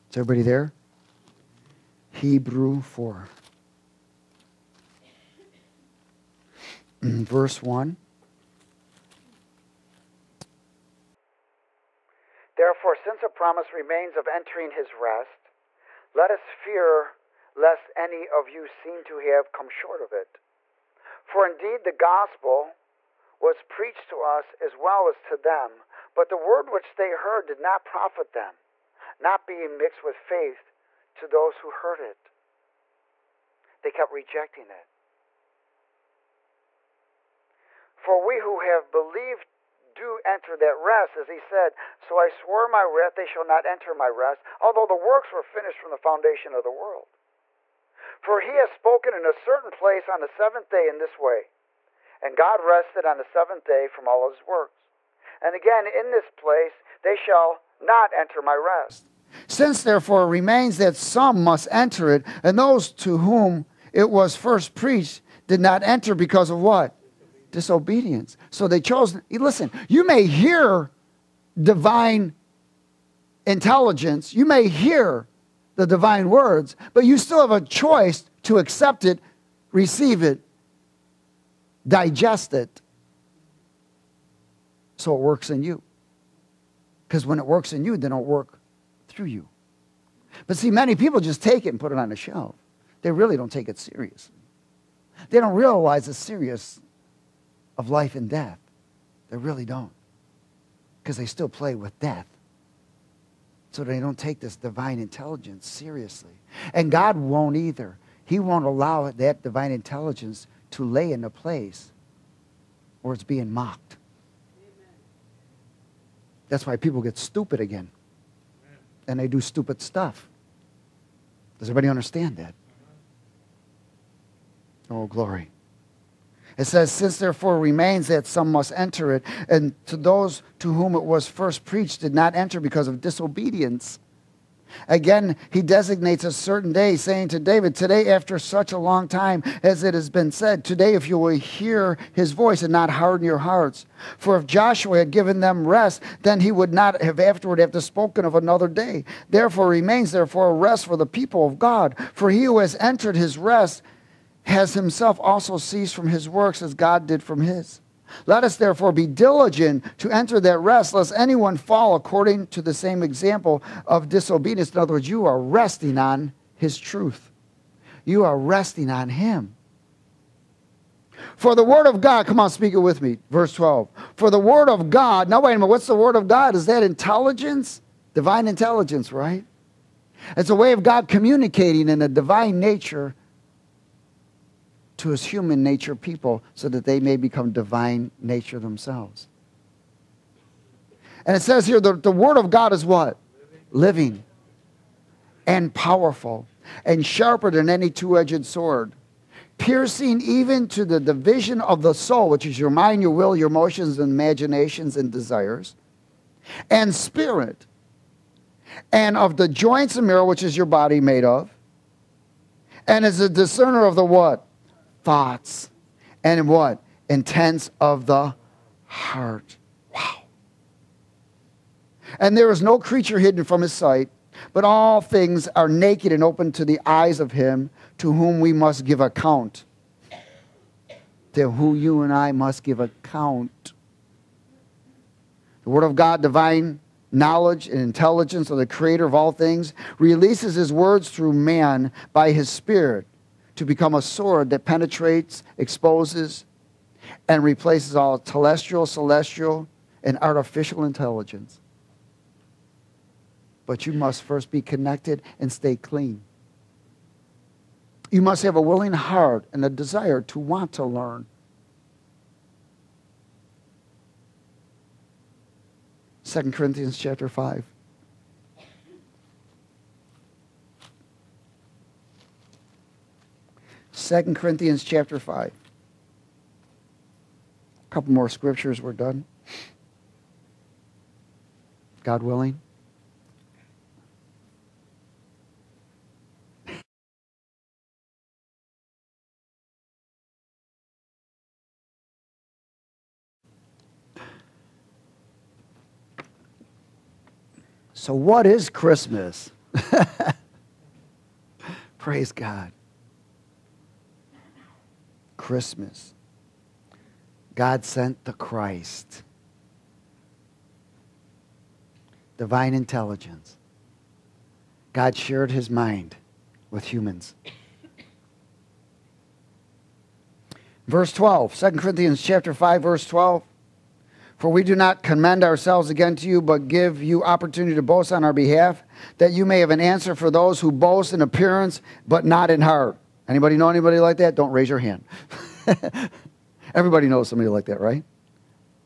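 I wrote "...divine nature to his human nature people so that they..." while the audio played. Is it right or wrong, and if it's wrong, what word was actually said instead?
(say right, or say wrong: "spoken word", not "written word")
right.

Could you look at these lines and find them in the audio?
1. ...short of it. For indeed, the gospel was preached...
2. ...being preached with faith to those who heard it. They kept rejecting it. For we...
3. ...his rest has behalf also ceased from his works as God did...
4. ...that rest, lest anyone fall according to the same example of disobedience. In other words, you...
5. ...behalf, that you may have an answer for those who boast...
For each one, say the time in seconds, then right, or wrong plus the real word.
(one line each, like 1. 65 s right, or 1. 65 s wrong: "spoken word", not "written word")
1. 19 s right
2. 29 s wrong: "mixed", not "preached"
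3. 153 s wrong: "himself", not "behalf"
4. 160 s right
5. 328 s right.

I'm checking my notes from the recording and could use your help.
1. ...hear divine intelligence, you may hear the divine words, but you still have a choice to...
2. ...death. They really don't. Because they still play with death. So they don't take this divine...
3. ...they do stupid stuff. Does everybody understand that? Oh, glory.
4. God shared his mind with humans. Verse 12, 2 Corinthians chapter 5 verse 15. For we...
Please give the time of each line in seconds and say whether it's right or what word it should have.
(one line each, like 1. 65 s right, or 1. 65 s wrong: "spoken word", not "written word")
1. 70 s right
2. 98 s right
3. 119 s right
4. 314 s wrong: "12", not "15".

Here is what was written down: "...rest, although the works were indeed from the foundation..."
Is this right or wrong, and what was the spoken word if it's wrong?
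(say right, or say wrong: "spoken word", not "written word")
wrong: "finished", not "indeed".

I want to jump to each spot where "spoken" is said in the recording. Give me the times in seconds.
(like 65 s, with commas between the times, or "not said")
48 s, 147 s.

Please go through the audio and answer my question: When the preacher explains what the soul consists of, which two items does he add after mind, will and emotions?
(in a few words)
Imaginations and desires.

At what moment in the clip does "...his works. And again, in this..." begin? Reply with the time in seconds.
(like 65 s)
54 s.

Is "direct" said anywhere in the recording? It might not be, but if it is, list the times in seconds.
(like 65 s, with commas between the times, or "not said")
not said.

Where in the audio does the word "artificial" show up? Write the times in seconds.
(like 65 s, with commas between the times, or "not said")
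250 s.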